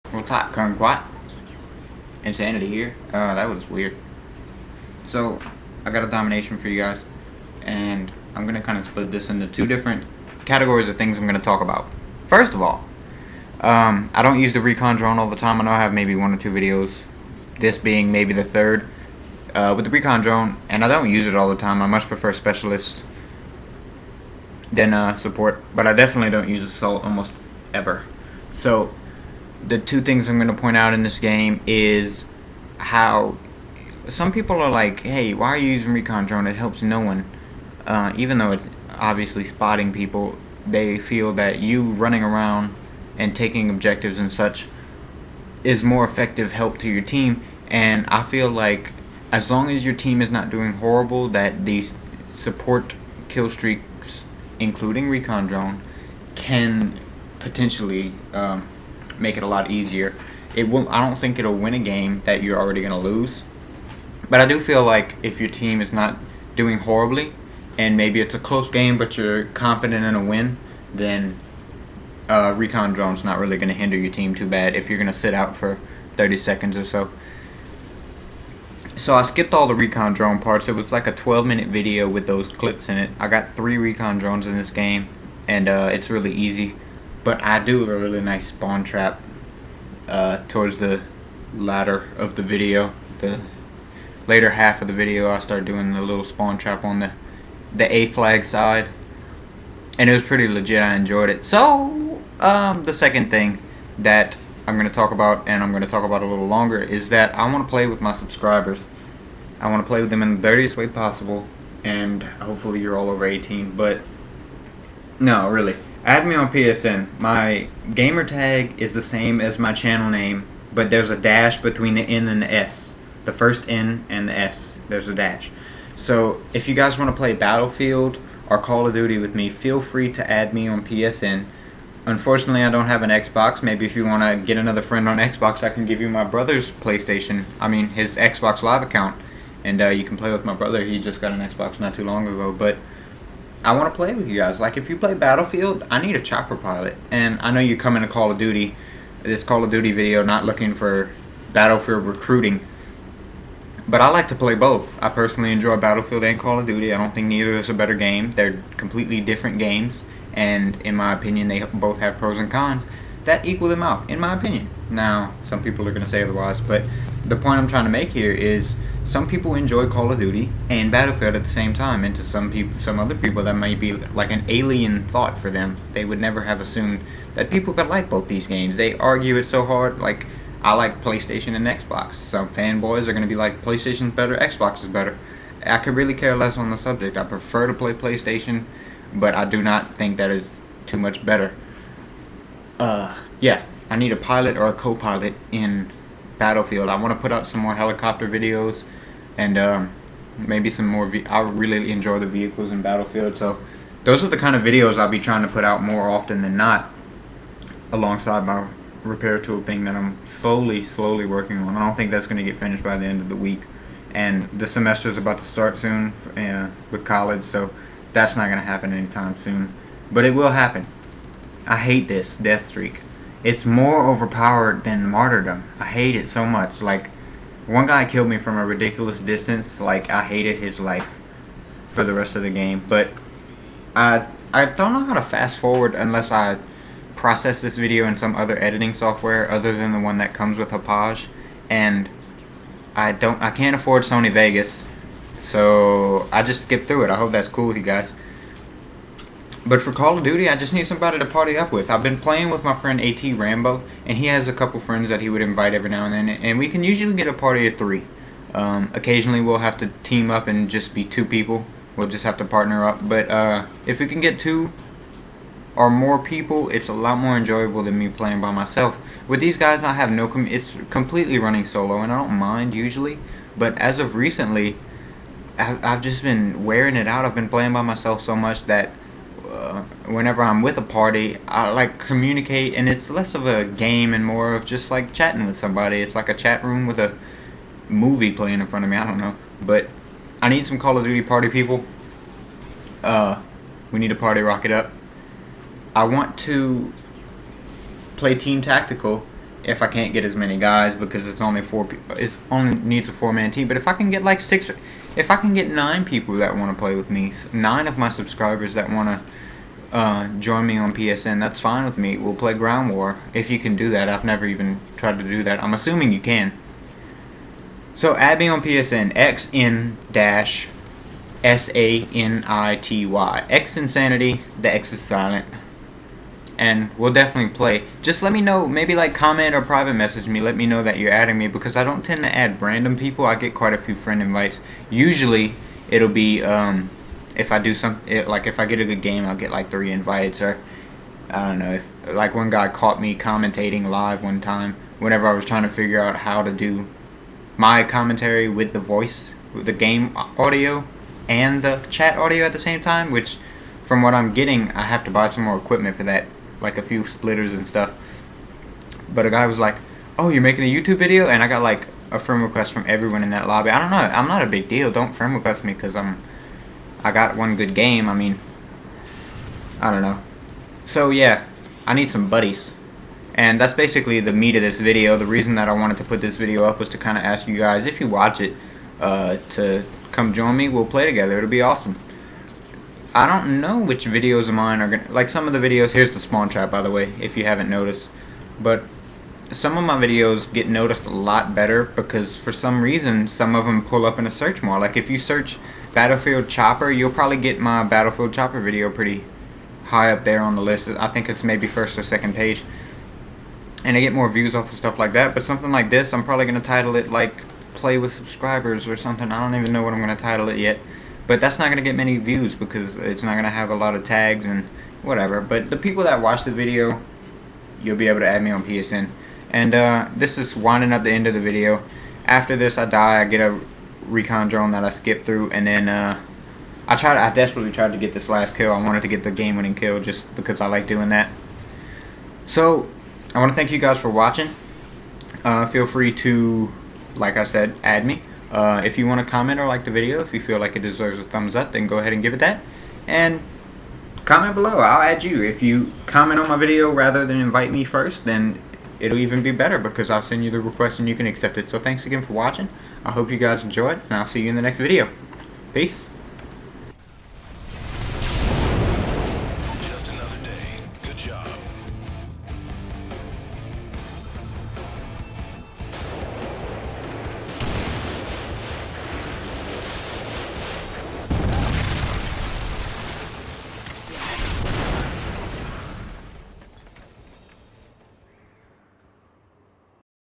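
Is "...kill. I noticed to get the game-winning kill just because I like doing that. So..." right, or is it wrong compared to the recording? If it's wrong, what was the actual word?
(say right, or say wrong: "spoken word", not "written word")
wrong: "wanted", not "noticed".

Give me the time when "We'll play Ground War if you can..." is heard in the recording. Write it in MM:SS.
05:12.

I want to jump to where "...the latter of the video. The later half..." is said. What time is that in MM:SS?
01:30.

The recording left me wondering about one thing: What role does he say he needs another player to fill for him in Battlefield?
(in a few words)
Chopper pilot.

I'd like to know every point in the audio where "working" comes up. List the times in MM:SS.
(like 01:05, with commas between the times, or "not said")
03:31.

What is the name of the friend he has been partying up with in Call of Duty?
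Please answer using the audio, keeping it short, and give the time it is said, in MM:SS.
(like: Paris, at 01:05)
AT Rambo, at 04:12.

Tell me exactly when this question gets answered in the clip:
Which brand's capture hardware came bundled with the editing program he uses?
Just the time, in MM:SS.
04:00.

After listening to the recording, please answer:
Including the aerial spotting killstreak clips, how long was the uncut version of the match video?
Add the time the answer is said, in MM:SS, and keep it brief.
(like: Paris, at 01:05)
12 minutes, at 01:21.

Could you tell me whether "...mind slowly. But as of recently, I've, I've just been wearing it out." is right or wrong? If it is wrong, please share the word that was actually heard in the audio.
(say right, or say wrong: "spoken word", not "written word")
wrong: "usually", not "slowly".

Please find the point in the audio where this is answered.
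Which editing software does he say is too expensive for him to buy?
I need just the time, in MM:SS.
04:04.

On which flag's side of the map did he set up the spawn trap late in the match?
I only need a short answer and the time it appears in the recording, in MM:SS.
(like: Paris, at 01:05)
A flag, at 01:37.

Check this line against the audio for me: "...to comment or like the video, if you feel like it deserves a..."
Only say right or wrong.
right.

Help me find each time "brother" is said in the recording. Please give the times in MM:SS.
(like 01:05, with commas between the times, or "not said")
02:16, 02:20.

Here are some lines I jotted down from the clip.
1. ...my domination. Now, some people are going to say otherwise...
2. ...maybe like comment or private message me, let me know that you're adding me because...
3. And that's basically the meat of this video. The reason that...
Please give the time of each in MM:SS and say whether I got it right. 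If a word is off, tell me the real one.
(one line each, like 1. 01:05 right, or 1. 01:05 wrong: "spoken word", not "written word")
1. 02:44 wrong: "opinion", not "domination"
2. 05:28 right
3. 06:13 right.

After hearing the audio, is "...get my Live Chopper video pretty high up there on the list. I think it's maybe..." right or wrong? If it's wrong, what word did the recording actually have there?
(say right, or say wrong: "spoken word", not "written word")
wrong: "Battlefield", not "Live".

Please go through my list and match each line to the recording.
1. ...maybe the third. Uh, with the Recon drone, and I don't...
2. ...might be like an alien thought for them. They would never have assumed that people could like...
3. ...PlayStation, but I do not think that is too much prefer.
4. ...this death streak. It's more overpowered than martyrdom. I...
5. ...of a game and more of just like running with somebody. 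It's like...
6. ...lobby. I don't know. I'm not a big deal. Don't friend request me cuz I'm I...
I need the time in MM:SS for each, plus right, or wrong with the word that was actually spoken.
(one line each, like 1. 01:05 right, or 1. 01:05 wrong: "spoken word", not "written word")
1. 00:18 right
2. 02:53 right
3. 03:07 wrong: "better", not "prefer"
4. 03:42 right
5. 04:43 wrong: "chatting", not "running"
6. 06:03 right.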